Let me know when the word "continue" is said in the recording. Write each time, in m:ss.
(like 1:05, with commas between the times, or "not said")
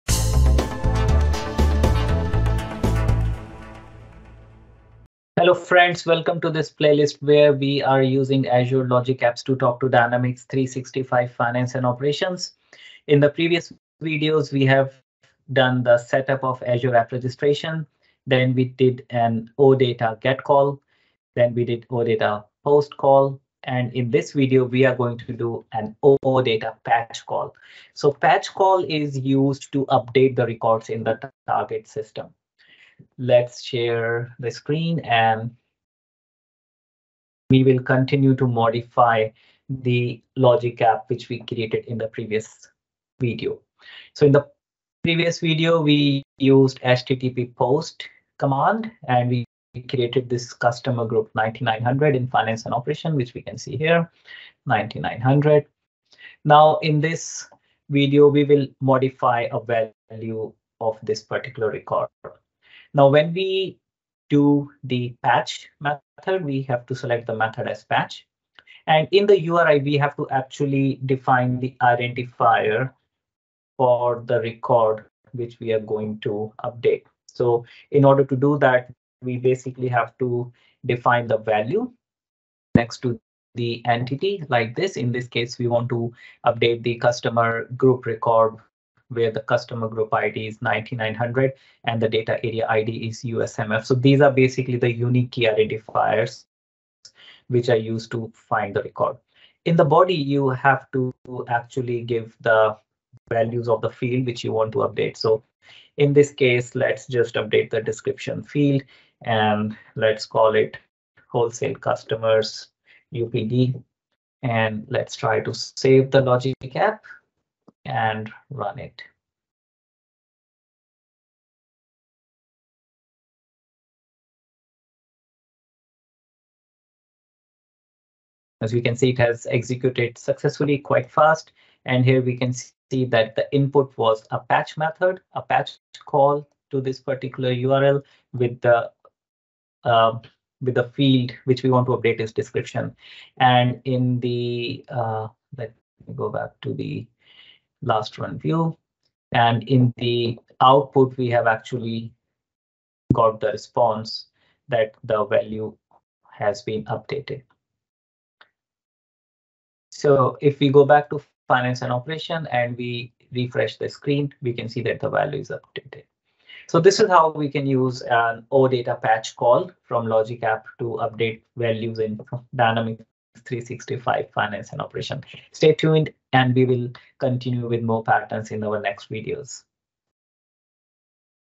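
0:37, 2:57.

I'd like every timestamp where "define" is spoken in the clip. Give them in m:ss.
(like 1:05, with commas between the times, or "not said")
1:11, 1:20.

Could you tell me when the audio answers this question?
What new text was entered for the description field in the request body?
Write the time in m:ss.
1:51.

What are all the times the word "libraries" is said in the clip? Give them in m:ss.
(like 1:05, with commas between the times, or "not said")
not said.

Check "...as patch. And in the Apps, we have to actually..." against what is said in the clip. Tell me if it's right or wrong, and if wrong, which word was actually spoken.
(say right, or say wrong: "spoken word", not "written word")
wrong: "URI", not "Apps".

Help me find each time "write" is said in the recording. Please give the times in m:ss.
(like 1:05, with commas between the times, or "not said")
not said.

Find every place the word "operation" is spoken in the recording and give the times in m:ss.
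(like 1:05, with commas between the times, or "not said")
0:11, 0:52, 2:41, 2:54.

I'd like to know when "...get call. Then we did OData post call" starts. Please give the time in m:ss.
0:20.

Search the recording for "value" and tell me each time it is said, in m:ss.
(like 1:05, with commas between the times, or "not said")
1:00, 1:21, 1:43, 2:35, 2:45, 2:51.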